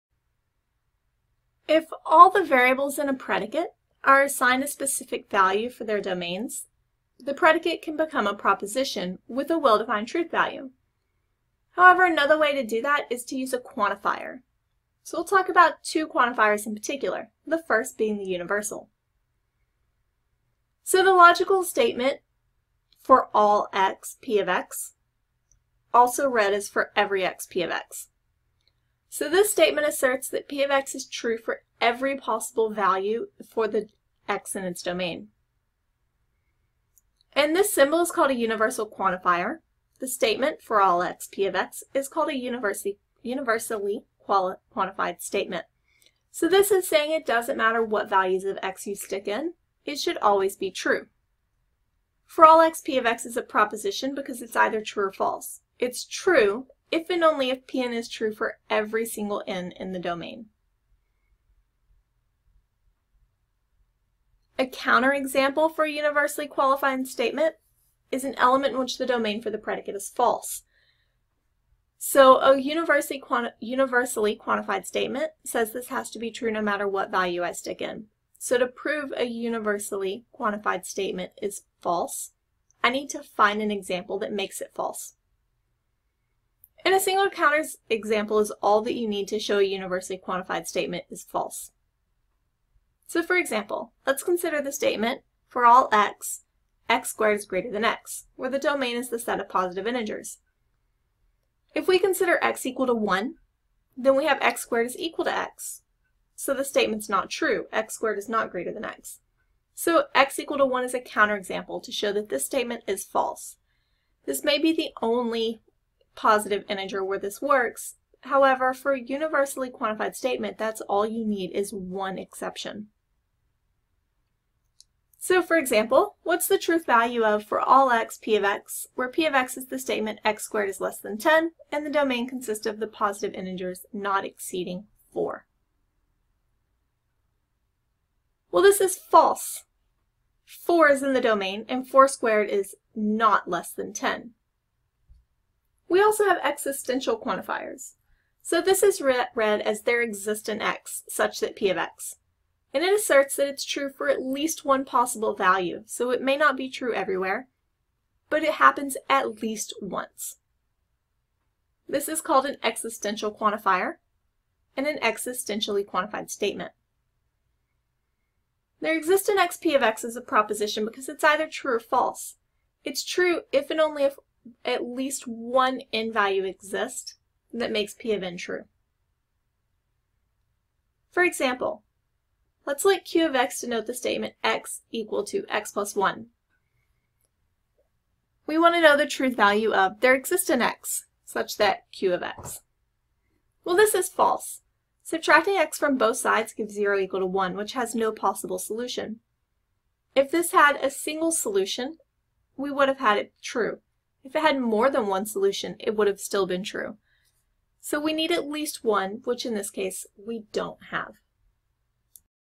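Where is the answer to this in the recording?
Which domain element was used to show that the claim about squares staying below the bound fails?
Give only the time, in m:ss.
2:20.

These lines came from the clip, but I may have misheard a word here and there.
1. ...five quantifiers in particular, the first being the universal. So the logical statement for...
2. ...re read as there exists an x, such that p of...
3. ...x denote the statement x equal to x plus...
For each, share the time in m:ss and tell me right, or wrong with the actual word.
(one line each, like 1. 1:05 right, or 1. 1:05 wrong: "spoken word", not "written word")
1. 0:15 wrong: "two", not "five"
2. 2:29 right
3. 3:03 right.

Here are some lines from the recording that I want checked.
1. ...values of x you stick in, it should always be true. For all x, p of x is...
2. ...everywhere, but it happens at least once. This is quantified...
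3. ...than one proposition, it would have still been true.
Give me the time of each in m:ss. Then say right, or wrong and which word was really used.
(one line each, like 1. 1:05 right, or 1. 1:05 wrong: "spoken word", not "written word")
1. 0:48 right
2. 2:36 wrong: "called", not "quantified"
3. 3:24 wrong: "solution", not "proposition".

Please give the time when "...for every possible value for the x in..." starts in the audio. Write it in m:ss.
0:31.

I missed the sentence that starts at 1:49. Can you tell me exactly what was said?
So x equal to 1 is a counterexample to show that this statement is false.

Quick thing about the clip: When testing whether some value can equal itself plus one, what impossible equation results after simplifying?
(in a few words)
0 equal to 1.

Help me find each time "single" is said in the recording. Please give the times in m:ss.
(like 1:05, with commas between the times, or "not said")
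0:59, 1:27, 3:20.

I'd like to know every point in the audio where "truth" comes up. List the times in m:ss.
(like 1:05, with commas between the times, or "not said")
0:10, 2:06, 3:09.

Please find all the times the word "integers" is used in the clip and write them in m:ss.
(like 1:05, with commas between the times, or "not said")
1:39, 1:56, 2:13.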